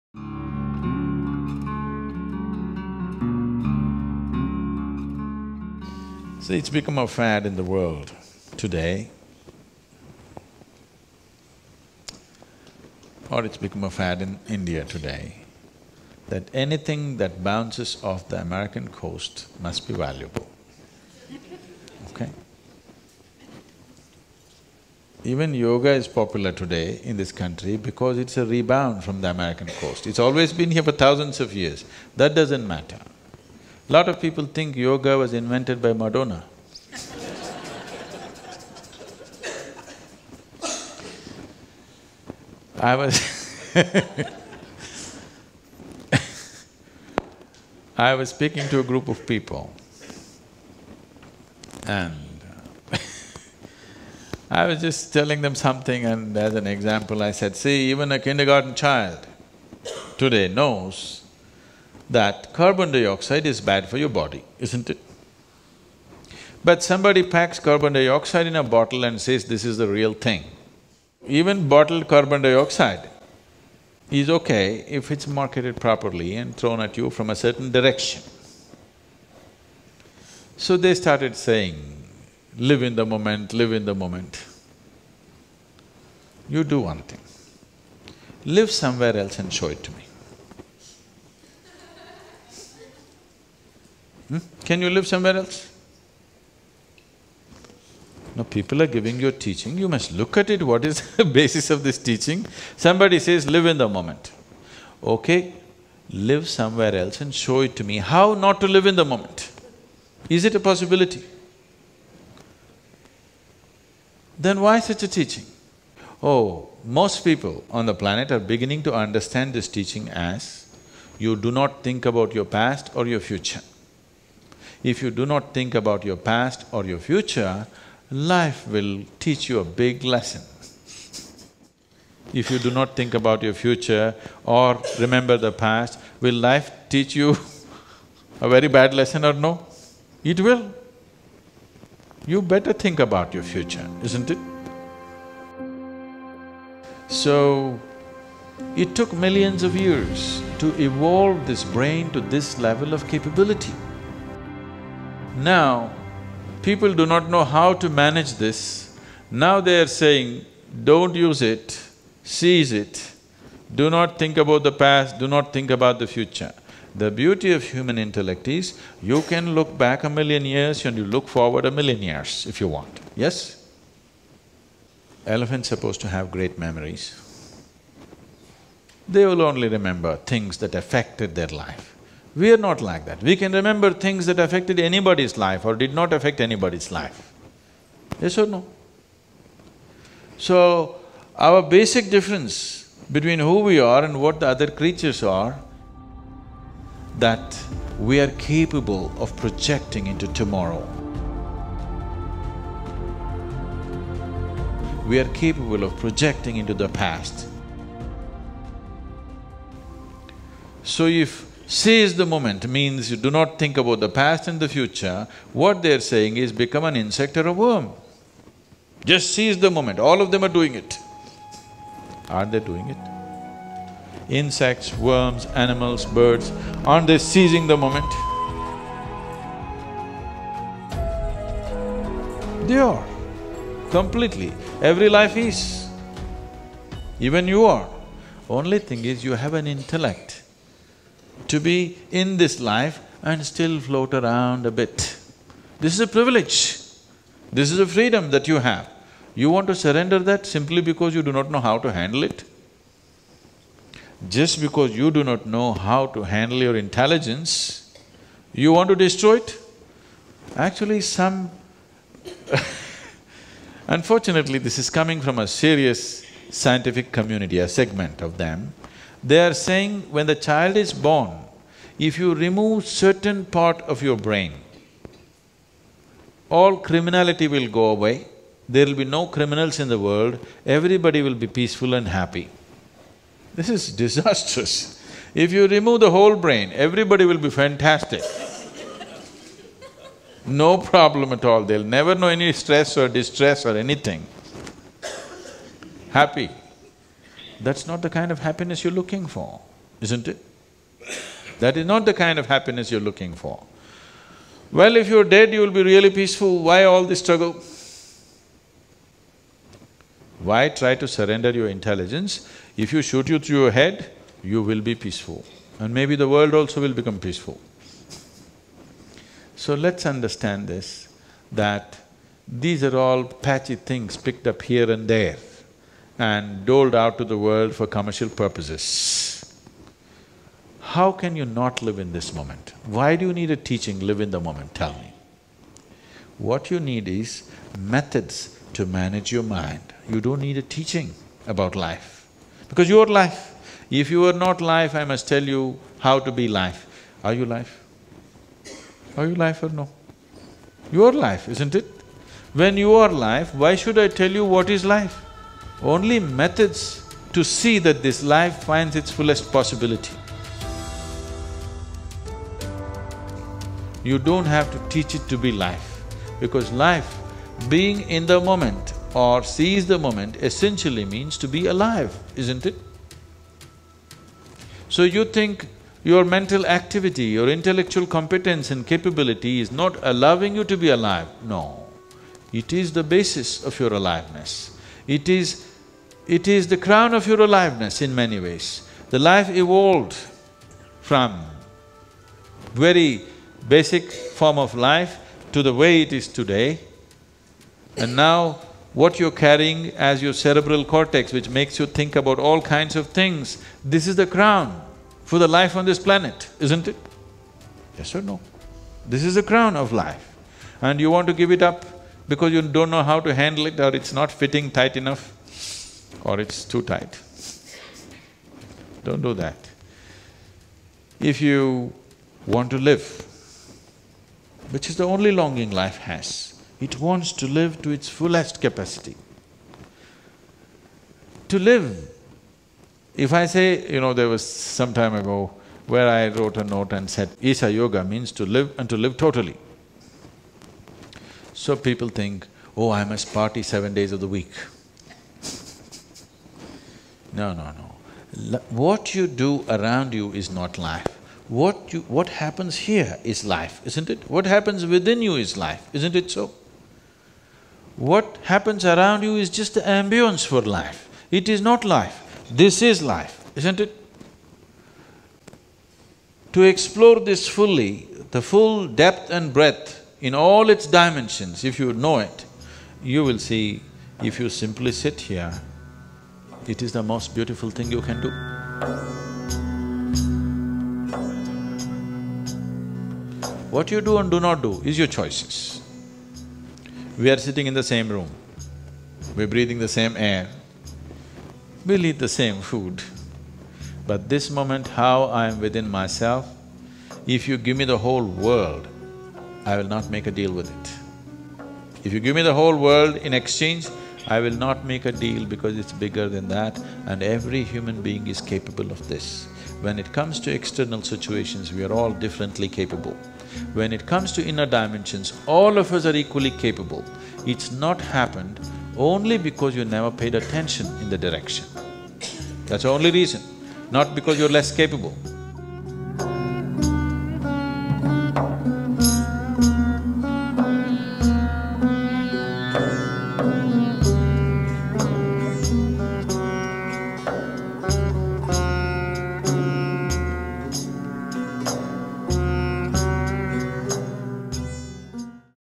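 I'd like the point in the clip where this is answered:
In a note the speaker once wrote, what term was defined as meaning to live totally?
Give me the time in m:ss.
7:17.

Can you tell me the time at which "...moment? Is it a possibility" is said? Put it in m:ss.
1:49.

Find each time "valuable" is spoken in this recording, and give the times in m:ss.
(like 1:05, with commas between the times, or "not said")
0:19.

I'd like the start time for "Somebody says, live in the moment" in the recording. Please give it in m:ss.
1:42.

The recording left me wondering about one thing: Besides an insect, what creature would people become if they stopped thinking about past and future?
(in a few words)
a worm.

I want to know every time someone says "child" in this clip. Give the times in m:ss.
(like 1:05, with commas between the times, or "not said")
0:58, 4:30.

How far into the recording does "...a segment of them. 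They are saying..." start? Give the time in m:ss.
4:27.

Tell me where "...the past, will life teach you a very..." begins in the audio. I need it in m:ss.
2:15.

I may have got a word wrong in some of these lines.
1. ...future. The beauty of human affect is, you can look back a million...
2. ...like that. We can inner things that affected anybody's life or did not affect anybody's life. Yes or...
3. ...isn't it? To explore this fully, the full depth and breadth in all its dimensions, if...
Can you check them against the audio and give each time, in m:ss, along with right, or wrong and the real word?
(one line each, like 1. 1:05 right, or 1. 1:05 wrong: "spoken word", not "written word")
1. 2:46 wrong: "intellect", not "affect"
2. 3:02 wrong: "remember", not "inner"
3. 7:43 right.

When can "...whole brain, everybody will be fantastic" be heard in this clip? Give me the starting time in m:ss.
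4:46.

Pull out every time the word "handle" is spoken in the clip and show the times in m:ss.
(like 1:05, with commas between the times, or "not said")
4:11, 4:16, 6:53.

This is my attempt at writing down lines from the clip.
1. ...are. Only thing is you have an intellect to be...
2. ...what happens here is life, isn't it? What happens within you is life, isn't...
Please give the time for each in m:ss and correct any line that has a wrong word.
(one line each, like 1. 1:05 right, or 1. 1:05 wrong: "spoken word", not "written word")
1. 3:57 right
2. 7:32 right.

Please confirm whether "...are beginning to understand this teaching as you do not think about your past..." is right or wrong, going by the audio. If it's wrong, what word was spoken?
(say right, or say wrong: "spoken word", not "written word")
right.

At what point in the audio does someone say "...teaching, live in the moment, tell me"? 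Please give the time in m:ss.
5:33.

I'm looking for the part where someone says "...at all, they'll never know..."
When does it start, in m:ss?
4:51.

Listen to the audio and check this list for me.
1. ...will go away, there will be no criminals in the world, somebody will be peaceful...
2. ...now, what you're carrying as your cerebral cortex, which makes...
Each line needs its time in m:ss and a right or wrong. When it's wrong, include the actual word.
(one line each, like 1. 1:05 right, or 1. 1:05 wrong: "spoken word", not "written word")
1. 4:37 wrong: "everybody", not "somebody"
2. 6:38 right.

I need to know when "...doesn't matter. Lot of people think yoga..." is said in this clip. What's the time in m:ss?
0:32.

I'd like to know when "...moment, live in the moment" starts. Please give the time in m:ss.
1:23.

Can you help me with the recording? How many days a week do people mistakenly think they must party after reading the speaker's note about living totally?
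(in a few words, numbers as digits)
7.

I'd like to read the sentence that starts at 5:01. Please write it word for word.
That is not the kind of happiness you're looking for.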